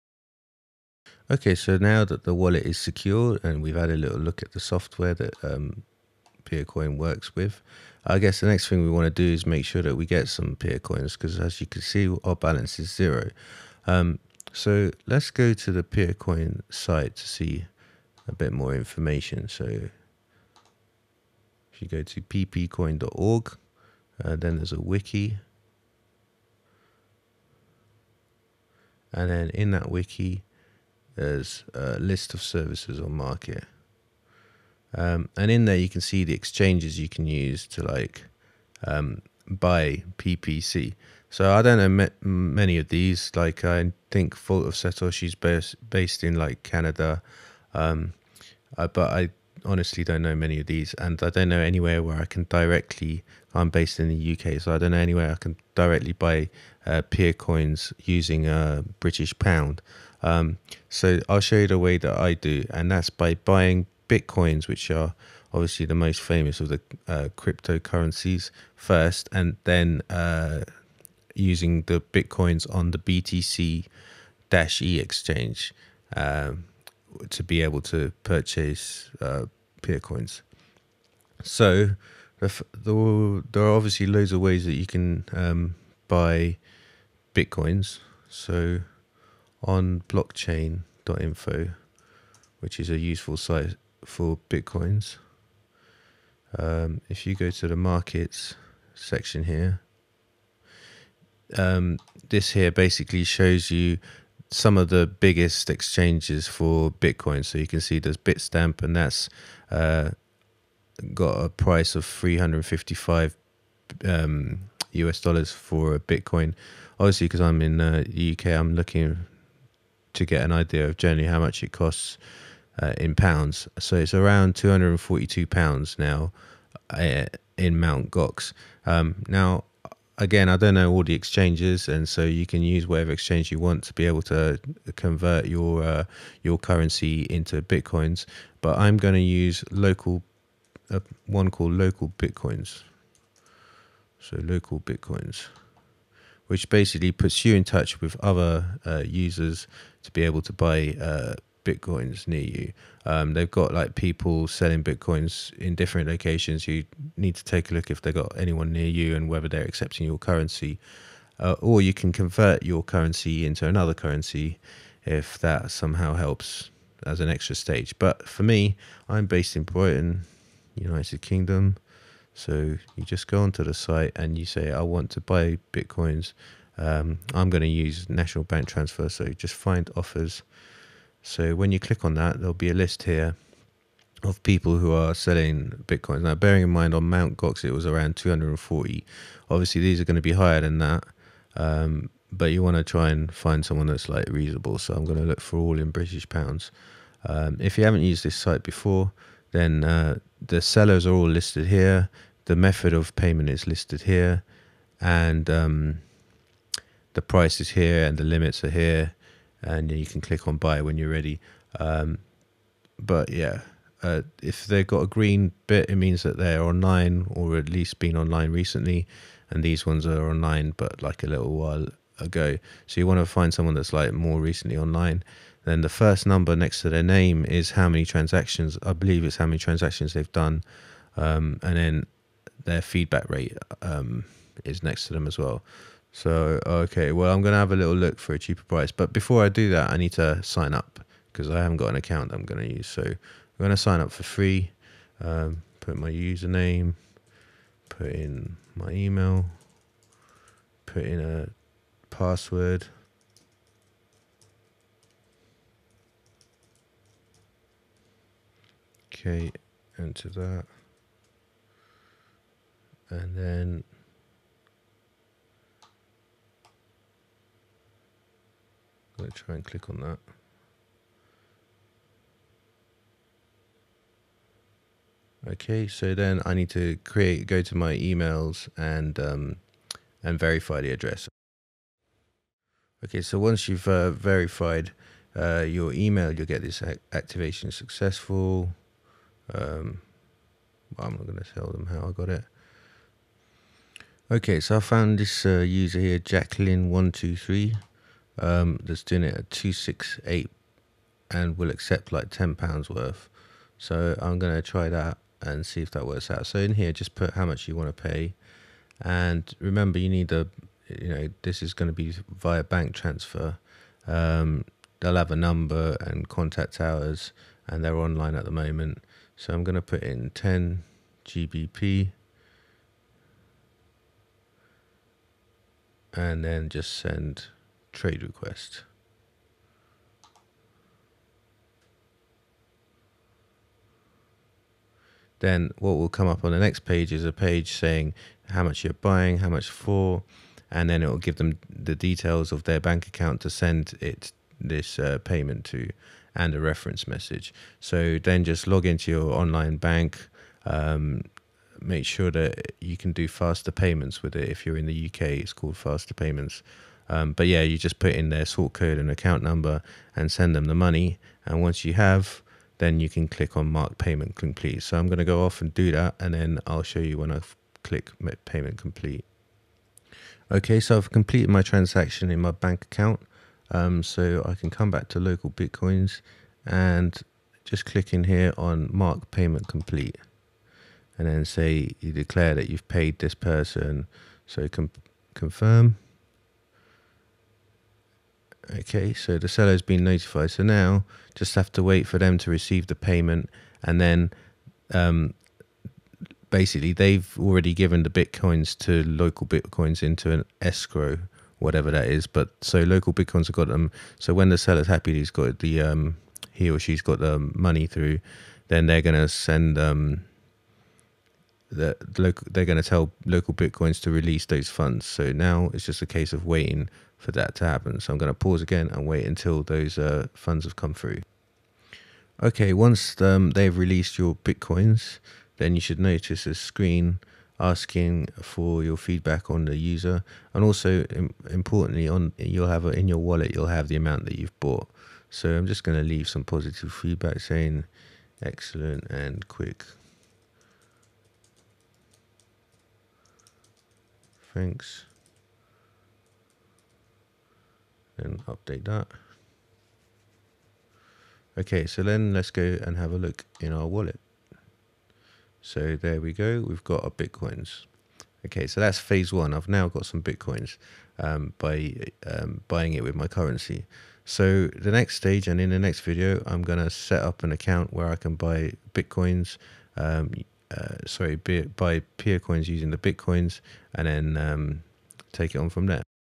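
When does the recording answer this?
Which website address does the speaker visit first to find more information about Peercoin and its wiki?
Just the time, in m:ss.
0:22.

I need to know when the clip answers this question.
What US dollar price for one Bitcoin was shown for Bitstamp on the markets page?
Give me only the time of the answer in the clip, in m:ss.
1:52.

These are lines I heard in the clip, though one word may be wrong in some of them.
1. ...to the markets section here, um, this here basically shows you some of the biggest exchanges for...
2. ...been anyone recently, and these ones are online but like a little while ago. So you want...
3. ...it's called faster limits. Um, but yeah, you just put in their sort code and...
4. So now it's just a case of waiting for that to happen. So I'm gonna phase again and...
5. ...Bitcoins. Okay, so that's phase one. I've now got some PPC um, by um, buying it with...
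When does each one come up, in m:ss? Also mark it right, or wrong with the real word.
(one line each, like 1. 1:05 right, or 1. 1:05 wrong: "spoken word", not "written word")
1. 1:37 right
2. 3:37 wrong: "online", not "anyone"
3. 5:55 wrong: "payments", not "limits"
4. 6:55 wrong: "pause", not "phase"
5. 7:37 wrong: "Bitcoins", not "PPC".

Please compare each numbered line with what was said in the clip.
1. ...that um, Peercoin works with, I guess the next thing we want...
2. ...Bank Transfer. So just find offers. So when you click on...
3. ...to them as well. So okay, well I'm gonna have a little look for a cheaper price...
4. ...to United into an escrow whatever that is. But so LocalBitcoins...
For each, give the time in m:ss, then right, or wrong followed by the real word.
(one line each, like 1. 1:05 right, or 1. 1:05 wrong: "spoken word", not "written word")
1. 0:05 right
2. 2:58 right
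3. 3:55 right
4. 6:38 wrong: "LocalBitcoins", not "United".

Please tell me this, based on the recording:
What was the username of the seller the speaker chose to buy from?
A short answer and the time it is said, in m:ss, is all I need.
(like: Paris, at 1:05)
Jacqueline123, at 4:56.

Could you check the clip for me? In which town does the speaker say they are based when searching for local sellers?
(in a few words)
Brighton.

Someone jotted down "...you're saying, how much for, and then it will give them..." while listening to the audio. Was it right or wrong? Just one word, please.
wrong.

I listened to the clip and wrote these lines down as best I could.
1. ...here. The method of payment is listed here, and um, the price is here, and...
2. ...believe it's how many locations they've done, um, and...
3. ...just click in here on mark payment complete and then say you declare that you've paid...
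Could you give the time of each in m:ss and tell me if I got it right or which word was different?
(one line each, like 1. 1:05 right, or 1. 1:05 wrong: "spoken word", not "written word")
1. 3:21 right
2. 3:48 wrong: "transactions", not "locations"
3. 6:17 right.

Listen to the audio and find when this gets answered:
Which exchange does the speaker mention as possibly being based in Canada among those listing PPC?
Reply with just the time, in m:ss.
0:44.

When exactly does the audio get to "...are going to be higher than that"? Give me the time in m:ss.
3:09.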